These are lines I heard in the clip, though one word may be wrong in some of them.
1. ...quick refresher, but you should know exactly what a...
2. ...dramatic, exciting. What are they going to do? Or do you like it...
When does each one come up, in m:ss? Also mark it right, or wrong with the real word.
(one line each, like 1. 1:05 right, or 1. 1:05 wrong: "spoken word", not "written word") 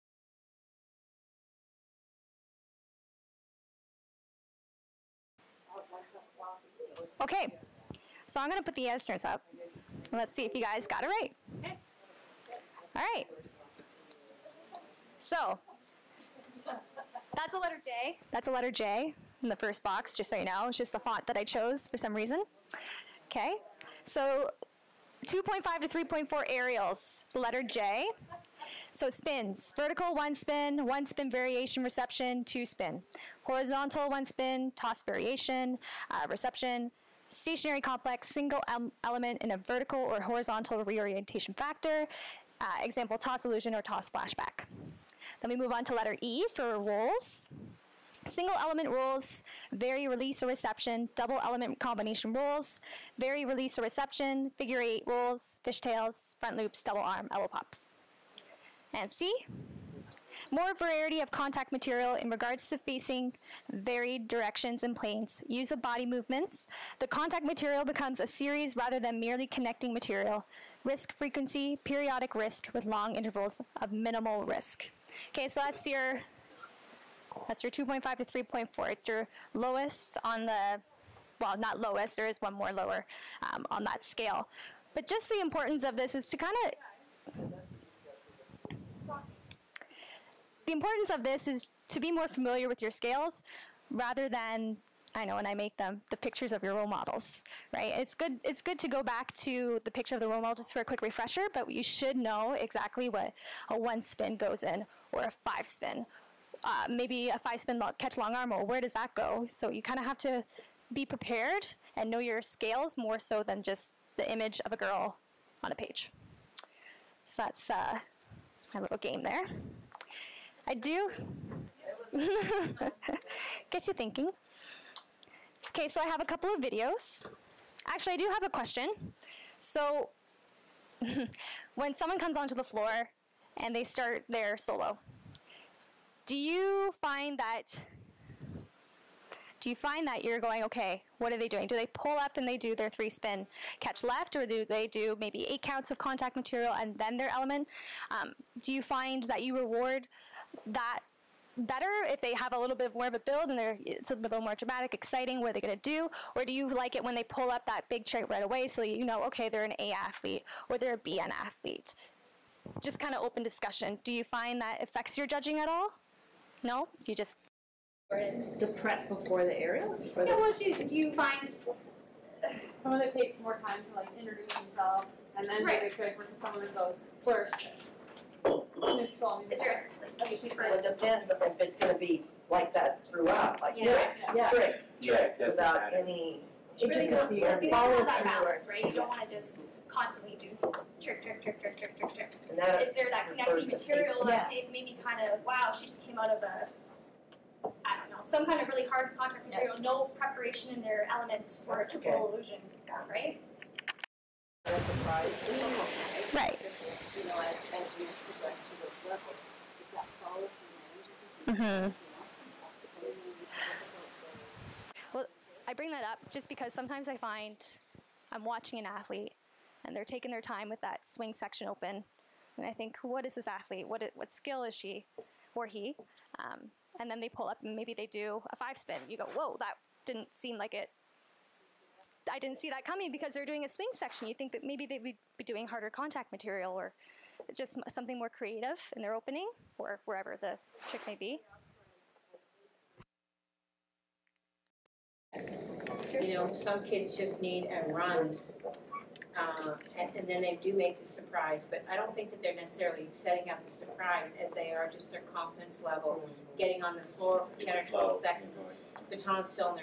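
1. 1:40 right
2. 2:34 right.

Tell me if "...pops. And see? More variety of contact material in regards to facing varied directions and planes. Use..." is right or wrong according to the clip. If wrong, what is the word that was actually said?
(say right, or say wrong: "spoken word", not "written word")
right.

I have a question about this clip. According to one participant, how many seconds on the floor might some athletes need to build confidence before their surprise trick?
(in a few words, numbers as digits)
10 or 12 seconds.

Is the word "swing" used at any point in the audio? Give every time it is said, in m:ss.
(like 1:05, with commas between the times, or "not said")
3:41, 3:53.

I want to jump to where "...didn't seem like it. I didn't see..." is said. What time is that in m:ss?
3:50.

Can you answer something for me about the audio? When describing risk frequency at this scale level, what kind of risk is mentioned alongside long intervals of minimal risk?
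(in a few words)
Periodic risk.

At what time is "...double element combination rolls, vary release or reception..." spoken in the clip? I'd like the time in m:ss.
0:51.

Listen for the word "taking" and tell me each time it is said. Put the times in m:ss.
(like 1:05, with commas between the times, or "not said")
3:40.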